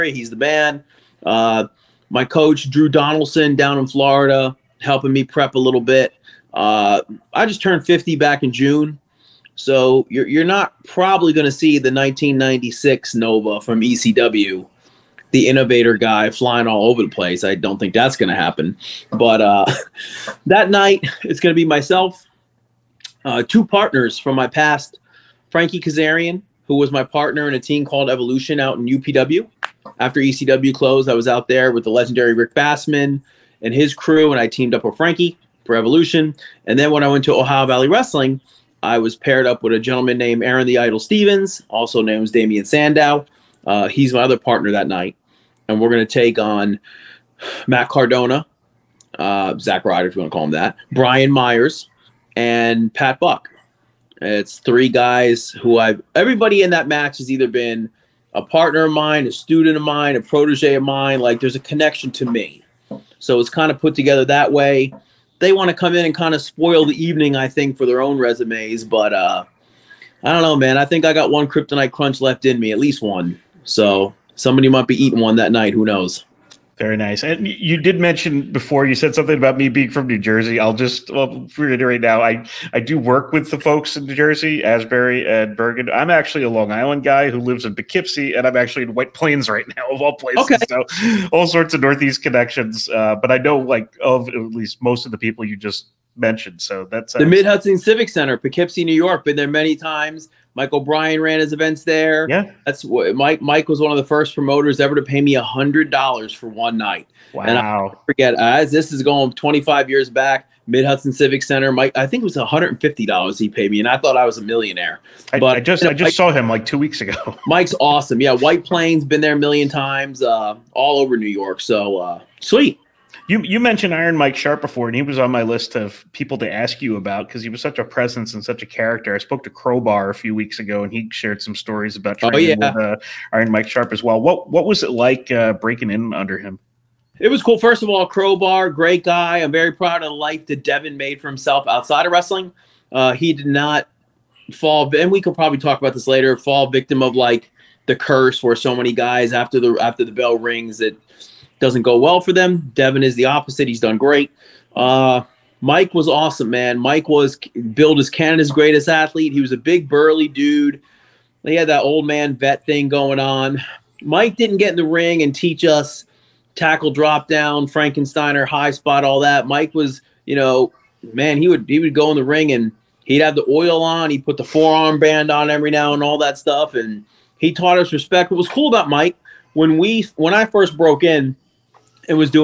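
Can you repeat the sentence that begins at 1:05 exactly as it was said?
They want to come in and kind of spoil the evening, I think, for their own resumes.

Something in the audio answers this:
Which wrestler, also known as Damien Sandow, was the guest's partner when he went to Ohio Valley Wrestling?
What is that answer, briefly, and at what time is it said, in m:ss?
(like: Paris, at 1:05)
Aron the Idol Stevens, at 0:40.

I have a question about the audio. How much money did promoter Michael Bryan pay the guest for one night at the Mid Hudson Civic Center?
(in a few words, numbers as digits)
$150.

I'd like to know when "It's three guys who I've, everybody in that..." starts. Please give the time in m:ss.
0:54.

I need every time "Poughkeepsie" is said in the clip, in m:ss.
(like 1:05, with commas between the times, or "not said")
1:27, 1:38.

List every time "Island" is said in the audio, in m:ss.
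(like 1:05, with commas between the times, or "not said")
1:26.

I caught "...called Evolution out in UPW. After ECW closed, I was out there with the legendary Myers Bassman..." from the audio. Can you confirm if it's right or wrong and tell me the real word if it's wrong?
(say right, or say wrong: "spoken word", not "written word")
wrong: "Rick", not "Myers".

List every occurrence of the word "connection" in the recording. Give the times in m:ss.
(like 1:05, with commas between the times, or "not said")
1:01, 1:32.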